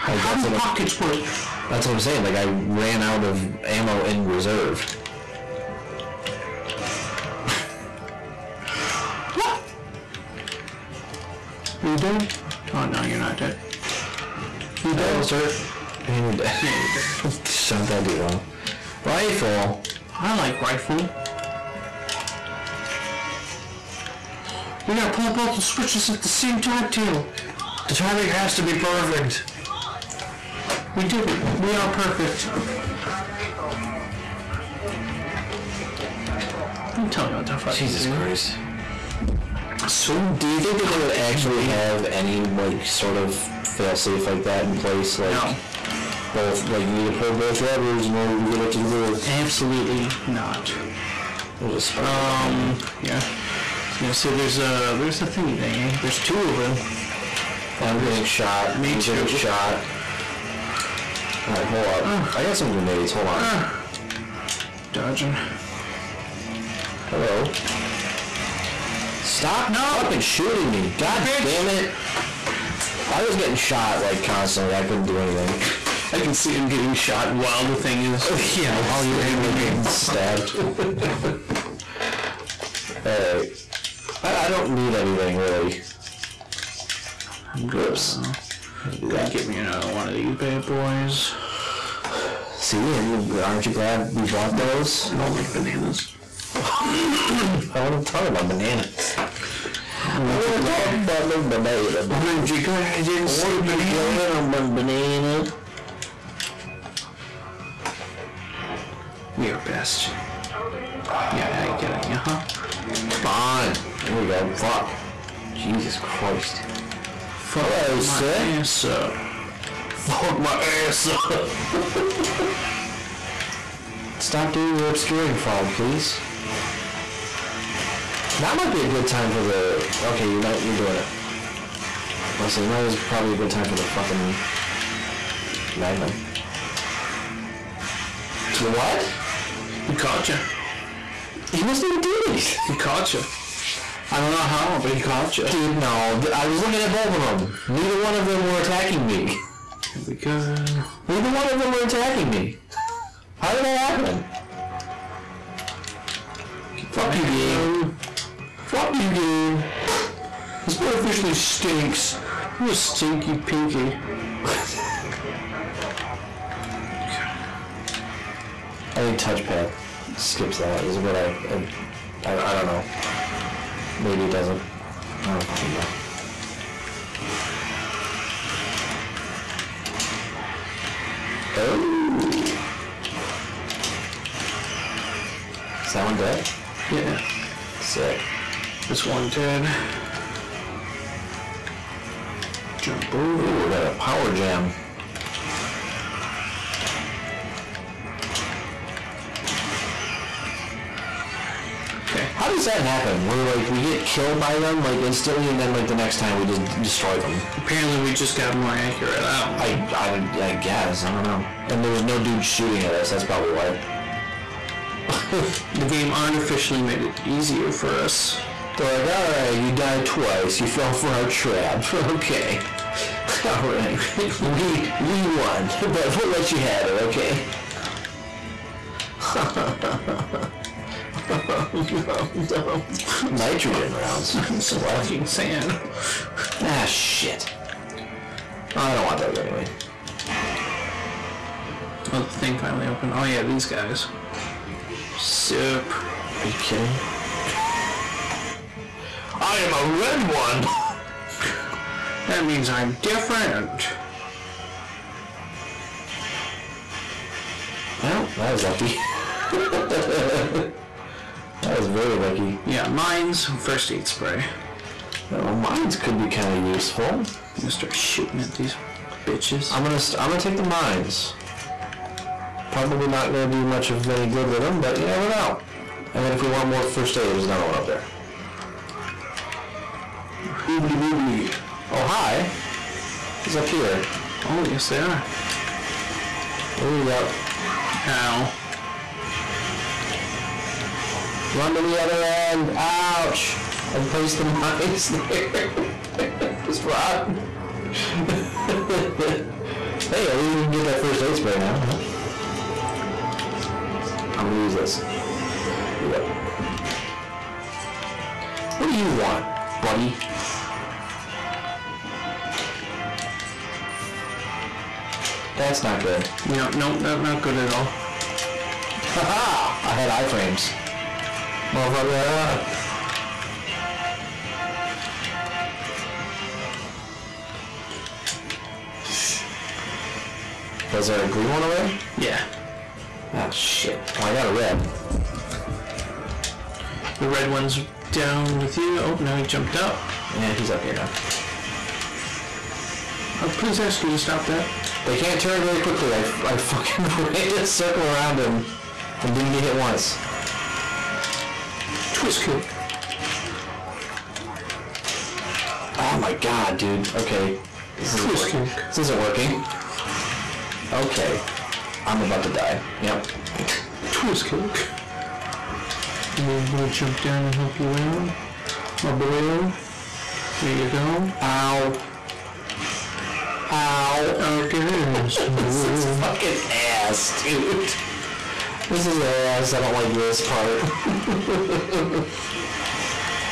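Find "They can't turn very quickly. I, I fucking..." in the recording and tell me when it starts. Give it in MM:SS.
05:45.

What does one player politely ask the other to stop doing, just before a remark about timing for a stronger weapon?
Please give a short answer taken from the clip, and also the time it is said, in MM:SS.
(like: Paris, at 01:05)
obscuring fog, at 02:04.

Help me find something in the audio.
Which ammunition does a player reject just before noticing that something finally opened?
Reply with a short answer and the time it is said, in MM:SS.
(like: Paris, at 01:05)
Nitrogen rounds, at 03:53.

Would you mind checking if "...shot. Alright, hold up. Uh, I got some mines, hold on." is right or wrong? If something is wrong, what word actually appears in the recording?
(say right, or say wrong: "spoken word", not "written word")
wrong: "grenades", not "mines".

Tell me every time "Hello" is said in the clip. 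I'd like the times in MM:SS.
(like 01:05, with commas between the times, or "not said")
00:14, 01:07, 01:57.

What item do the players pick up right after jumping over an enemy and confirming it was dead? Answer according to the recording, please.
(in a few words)
power gem.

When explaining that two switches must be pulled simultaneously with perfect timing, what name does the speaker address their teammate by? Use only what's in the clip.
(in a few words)
Taylor.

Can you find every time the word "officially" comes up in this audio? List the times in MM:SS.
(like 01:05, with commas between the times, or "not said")
02:40.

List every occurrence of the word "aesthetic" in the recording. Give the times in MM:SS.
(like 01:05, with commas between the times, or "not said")
not said.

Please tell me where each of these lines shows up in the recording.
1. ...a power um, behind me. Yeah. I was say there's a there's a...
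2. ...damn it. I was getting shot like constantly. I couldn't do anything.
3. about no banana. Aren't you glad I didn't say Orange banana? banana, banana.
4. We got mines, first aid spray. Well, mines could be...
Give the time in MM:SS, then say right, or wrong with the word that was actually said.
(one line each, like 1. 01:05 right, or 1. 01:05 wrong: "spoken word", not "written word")
1. 00:51 wrong: "spider", not "power"
2. 01:11 right
3. 01:41 right
4. 04:22 right.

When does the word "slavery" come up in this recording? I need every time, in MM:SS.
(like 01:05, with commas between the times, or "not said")
not said.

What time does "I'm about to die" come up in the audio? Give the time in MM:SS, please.
06:02.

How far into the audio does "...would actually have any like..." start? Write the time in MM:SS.
00:40.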